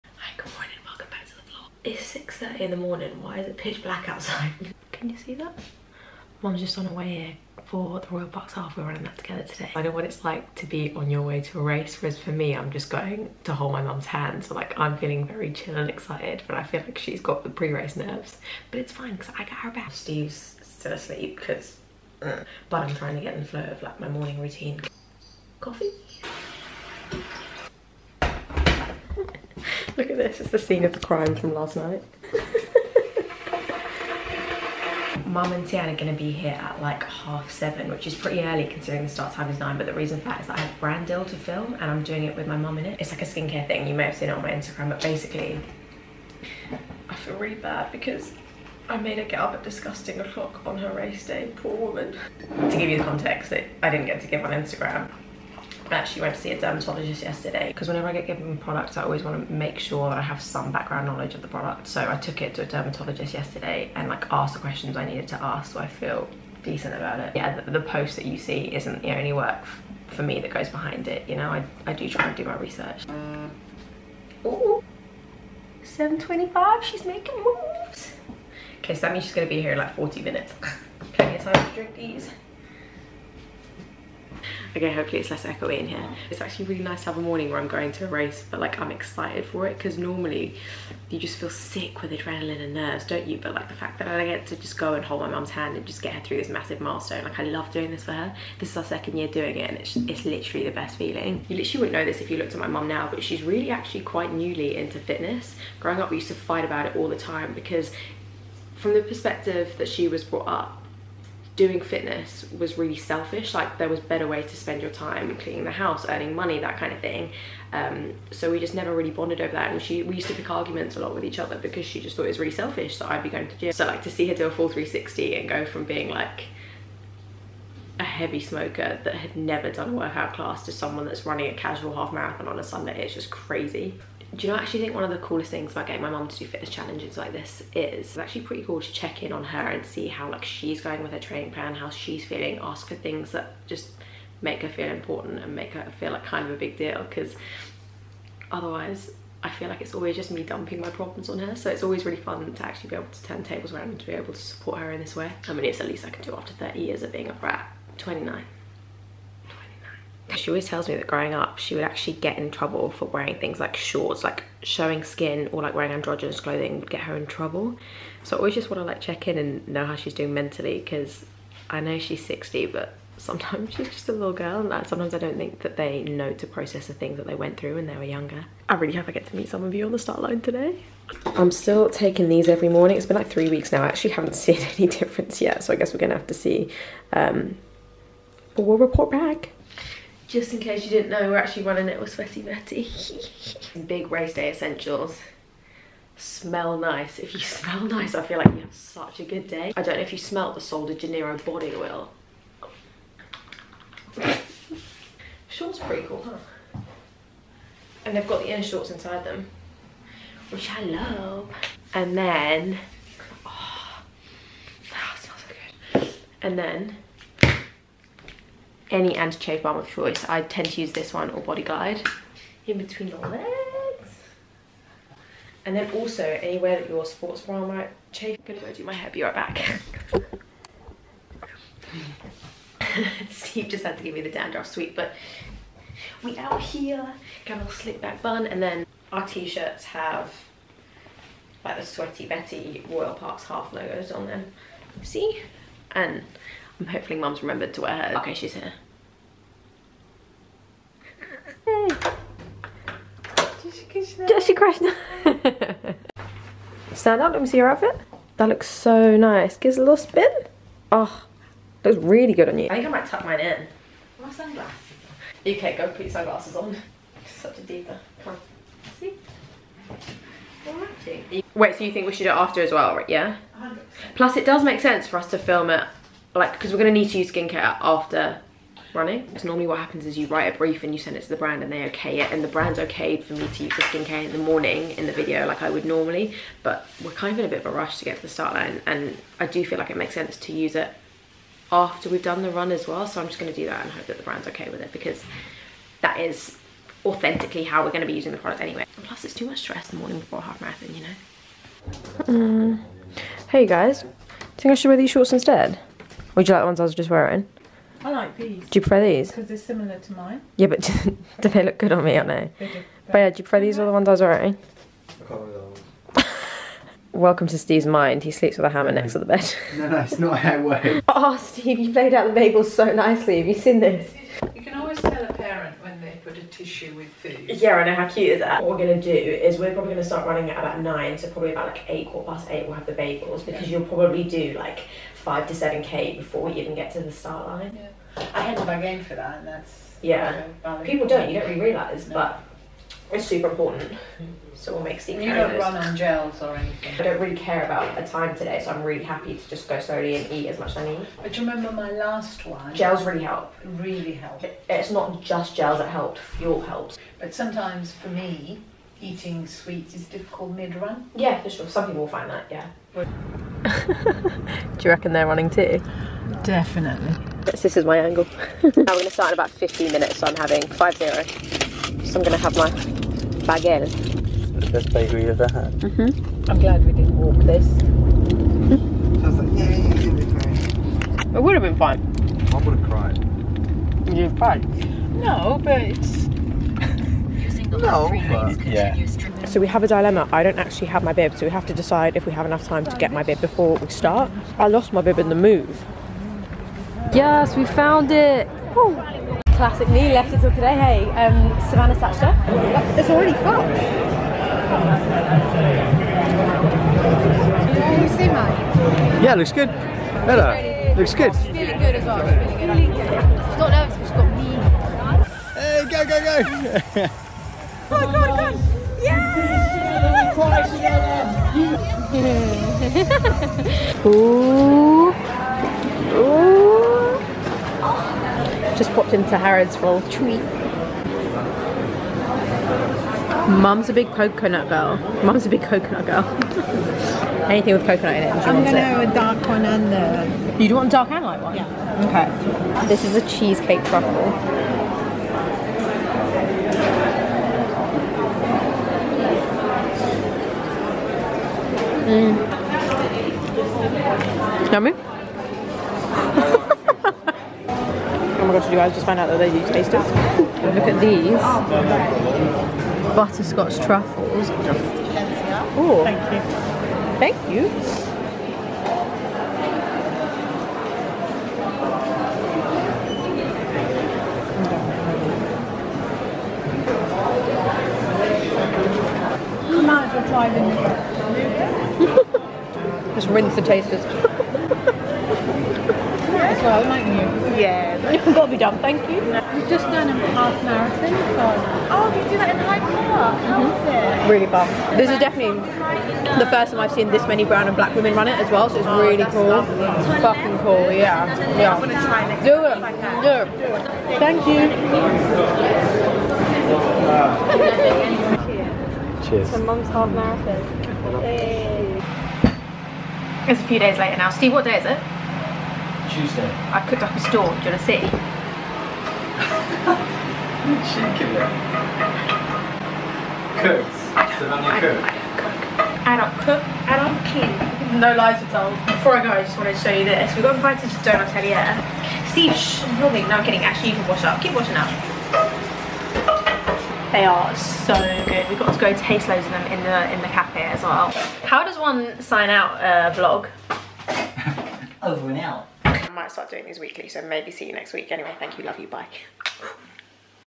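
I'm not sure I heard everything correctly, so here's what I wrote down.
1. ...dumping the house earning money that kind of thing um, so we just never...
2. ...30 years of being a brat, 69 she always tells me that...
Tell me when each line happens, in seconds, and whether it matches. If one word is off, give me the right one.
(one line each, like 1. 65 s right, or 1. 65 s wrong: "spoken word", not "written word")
1. 115 s wrong: "cleaning", not "dumping"
2. 156 s wrong: "29", not "69".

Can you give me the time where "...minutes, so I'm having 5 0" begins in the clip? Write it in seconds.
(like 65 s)
369 s.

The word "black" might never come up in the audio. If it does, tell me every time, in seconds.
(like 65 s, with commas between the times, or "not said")
3 s, 497 s.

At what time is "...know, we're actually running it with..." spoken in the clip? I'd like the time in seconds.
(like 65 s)
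191 s.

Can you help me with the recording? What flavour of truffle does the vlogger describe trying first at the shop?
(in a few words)
cheesecake.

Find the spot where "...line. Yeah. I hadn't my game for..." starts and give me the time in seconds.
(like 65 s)
337 s.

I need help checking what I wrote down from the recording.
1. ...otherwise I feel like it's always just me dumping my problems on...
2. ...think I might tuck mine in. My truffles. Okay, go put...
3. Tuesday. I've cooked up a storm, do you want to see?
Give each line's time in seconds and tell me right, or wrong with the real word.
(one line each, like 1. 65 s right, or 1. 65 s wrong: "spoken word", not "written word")
1. 148 s right
2. 262 s wrong: "sunglasses", not "truffles"
3. 516 s right.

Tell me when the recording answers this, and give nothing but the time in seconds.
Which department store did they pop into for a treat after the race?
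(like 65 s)
429 s.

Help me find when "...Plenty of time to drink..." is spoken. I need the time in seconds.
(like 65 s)
81 s.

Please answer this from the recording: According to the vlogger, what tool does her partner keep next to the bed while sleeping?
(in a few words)
hammer.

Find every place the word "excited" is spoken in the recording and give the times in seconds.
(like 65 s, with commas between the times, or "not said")
15 s, 88 s.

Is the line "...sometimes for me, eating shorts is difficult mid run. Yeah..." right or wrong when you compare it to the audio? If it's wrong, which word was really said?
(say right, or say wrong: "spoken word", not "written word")
wrong: "sweets", not "shorts".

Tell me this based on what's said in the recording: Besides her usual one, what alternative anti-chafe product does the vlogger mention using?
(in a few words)
Body Glide.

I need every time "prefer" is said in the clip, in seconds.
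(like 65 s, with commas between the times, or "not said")
308 s, 313 s.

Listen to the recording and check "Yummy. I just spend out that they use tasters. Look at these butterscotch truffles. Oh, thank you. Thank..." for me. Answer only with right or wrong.
wrong.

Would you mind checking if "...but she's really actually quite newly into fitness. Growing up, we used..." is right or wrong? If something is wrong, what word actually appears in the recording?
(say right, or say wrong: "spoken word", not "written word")
right.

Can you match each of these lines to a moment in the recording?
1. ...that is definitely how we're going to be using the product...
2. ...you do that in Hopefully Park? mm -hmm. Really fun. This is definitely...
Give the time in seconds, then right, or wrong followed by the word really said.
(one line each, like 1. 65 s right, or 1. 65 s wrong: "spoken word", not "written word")
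1. 296 s wrong: "authentically", not "definitely"
2. 492 s wrong: "Hyde", not "Hopefully".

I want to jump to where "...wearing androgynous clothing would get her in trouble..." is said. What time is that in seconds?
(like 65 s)
165 s.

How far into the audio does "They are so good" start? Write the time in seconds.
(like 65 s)
537 s.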